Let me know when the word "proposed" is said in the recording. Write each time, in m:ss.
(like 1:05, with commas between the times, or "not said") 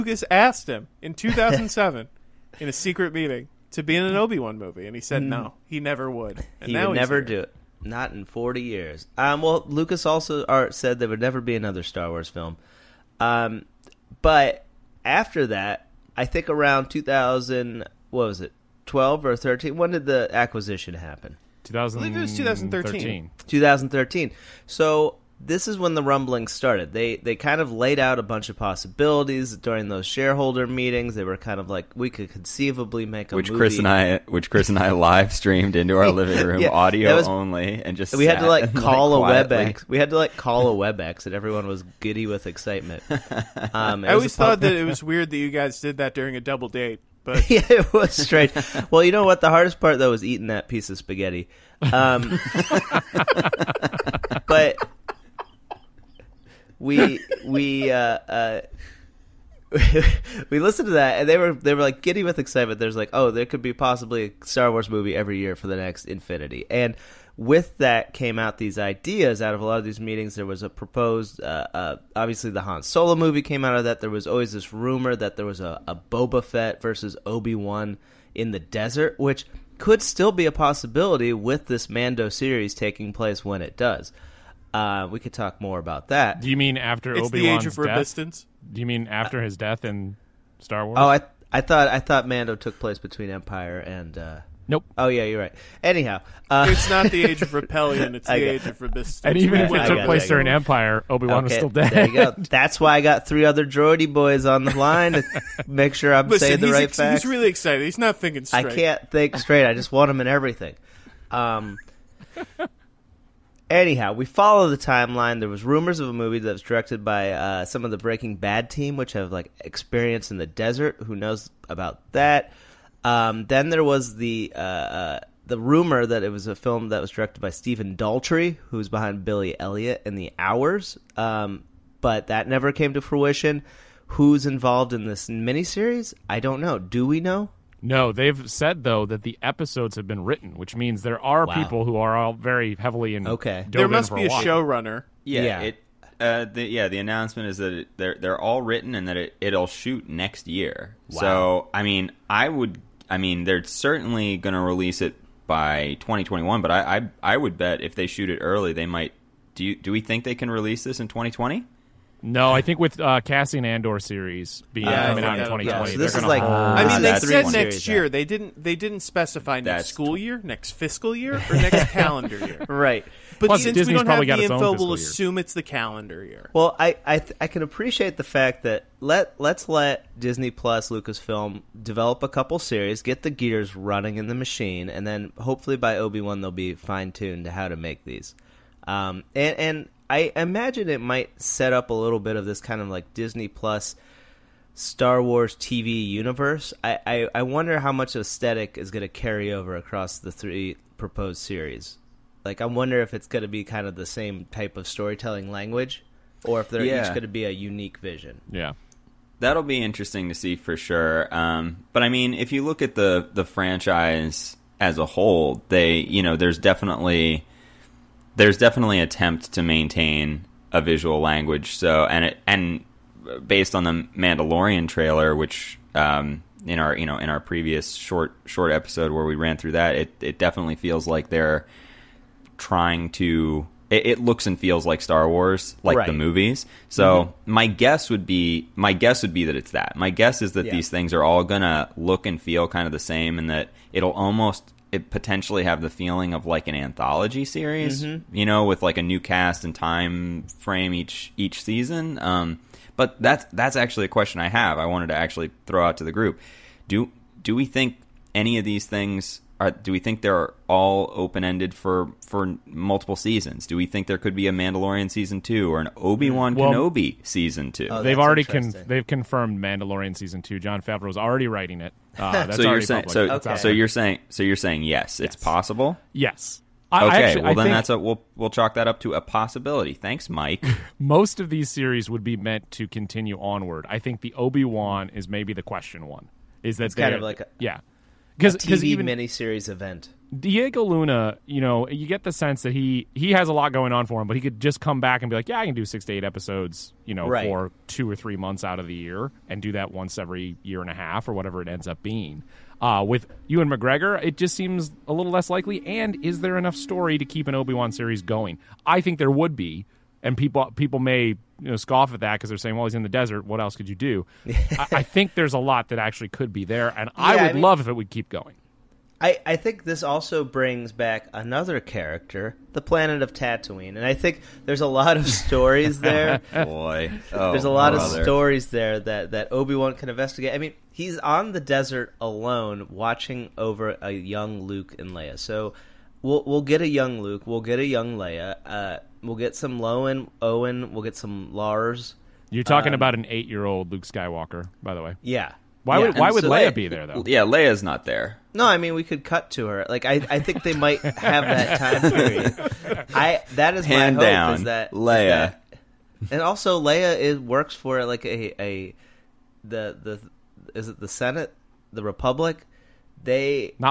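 1:10, 3:20.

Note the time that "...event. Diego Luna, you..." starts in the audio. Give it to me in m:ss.
4:49.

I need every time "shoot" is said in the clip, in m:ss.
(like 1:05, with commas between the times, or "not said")
2:29, 2:38.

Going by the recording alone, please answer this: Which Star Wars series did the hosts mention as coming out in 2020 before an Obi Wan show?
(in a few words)
Andor.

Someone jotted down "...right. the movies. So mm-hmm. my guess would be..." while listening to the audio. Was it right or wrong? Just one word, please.
right.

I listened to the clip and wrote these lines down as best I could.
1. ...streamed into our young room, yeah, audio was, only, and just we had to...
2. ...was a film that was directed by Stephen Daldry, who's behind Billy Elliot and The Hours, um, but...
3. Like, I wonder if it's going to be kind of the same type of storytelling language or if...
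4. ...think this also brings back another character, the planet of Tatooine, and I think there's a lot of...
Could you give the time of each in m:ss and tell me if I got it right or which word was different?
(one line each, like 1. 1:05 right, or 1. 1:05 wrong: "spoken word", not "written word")
1. 0:35 wrong: "living", not "young"
2. 2:06 right
3. 3:22 right
4. 5:19 right.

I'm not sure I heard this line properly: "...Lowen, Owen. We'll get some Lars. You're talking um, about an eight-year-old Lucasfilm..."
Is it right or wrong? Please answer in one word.
wrong.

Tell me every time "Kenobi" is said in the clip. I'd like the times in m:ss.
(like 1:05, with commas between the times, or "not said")
4:26.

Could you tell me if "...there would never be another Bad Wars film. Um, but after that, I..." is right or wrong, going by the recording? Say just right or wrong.
wrong.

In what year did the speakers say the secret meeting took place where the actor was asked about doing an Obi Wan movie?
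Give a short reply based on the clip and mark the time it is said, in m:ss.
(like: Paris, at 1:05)
2007, at 0:01.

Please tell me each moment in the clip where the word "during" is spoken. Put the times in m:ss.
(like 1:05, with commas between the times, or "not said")
0:29, 0:46, 1:40.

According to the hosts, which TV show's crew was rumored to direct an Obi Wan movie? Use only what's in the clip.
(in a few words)
Breaking Bad.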